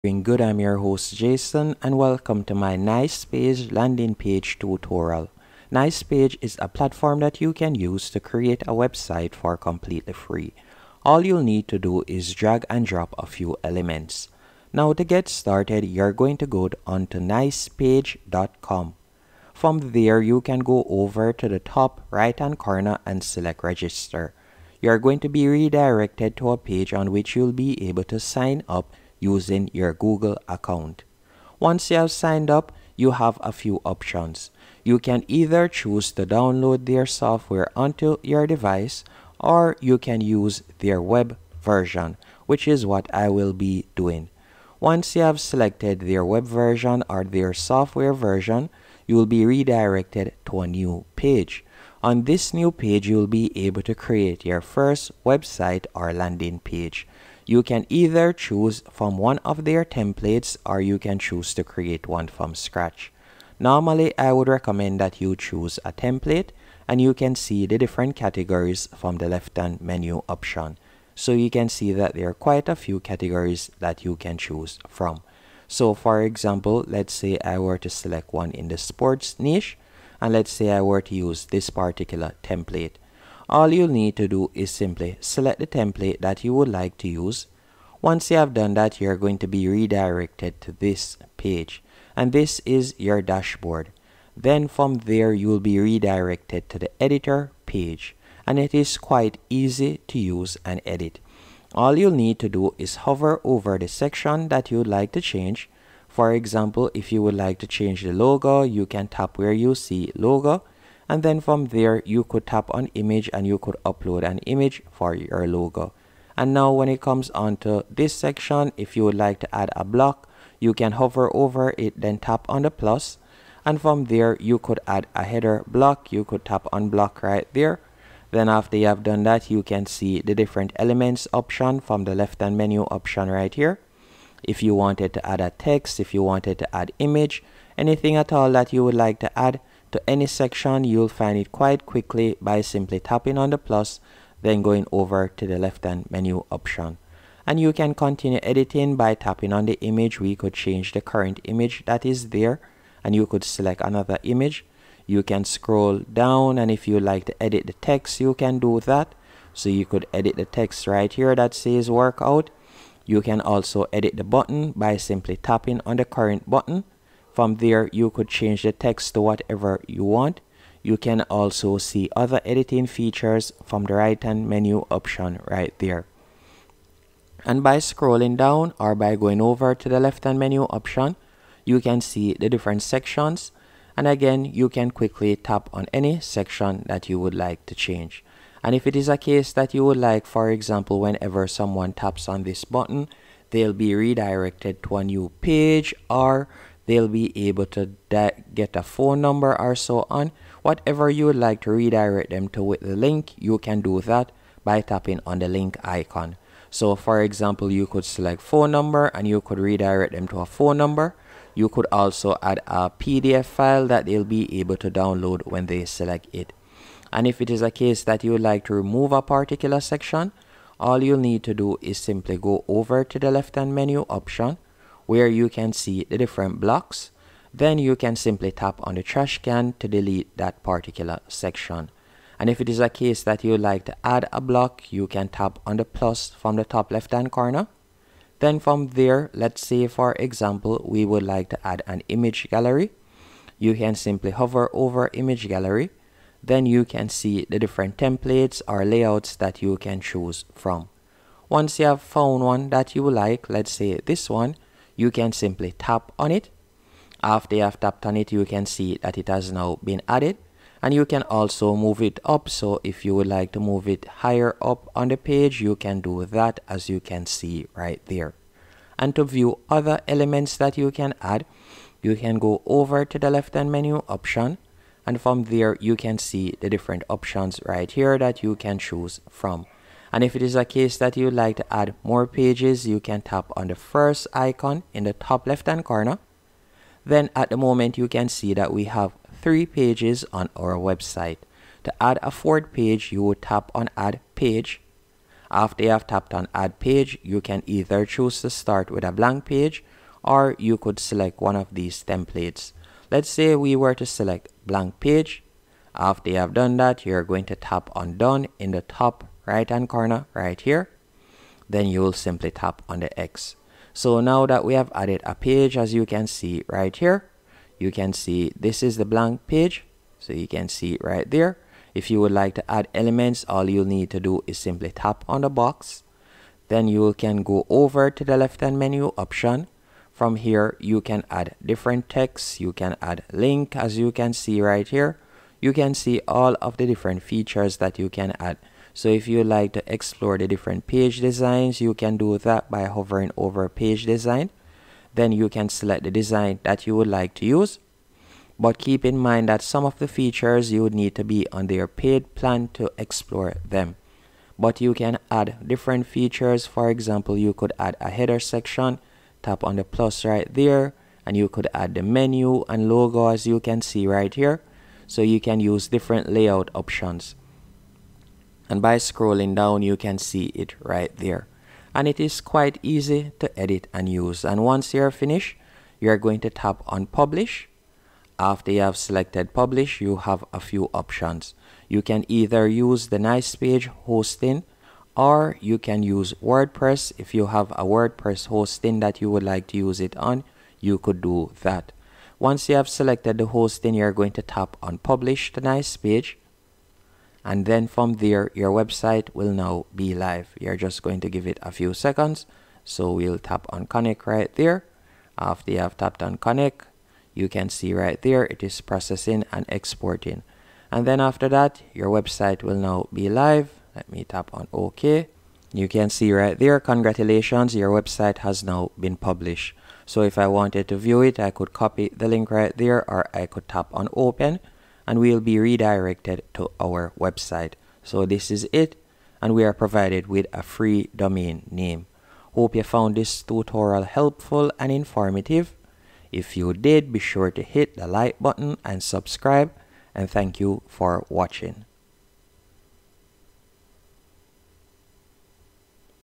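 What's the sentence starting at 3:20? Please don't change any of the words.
Whatever you would like to redirect them to with the link, you can do that by tapping on the link icon.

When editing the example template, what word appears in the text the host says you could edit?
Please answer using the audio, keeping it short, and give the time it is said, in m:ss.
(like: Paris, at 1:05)
workout, at 2:41.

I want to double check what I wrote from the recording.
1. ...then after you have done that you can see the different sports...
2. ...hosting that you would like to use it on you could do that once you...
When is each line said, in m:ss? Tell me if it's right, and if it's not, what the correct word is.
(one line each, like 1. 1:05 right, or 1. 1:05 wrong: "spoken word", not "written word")
1. 2:08 wrong: "elements", not "sports"
2. 6:28 right.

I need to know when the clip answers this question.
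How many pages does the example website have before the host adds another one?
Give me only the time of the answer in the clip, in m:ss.
4:49.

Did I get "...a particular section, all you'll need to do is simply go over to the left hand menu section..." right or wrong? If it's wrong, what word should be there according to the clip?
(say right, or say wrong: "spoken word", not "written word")
wrong: "option", not "section".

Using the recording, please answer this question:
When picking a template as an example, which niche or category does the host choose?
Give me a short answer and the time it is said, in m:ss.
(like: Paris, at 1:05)
sports, at 1:18.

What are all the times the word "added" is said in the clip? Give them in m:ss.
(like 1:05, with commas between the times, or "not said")
4:20, 5:14.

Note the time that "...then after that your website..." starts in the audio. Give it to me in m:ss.
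6:51.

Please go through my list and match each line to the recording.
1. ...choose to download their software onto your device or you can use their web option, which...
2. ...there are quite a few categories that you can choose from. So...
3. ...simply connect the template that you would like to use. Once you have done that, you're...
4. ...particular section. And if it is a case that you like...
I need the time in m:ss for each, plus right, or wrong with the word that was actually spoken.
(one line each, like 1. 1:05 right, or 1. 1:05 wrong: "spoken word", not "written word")
1. 0:35 wrong: "version", not "option"
2. 1:12 right
3. 1:24 wrong: "select", not "connect"
4. 3:50 right.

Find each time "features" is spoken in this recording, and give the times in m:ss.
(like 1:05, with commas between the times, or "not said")
2:52, 5:37, 5:50, 5:56.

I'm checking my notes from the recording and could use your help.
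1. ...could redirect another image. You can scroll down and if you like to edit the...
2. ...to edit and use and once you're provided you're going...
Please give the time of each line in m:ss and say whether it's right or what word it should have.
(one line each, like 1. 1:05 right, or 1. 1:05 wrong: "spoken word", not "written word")
1. 2:33 wrong: "select", not "redirect"
2. 6:13 wrong: "finished", not "provided".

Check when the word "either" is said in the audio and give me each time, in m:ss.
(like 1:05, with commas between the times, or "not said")
0:35, 0:57, 4:57, 6:22.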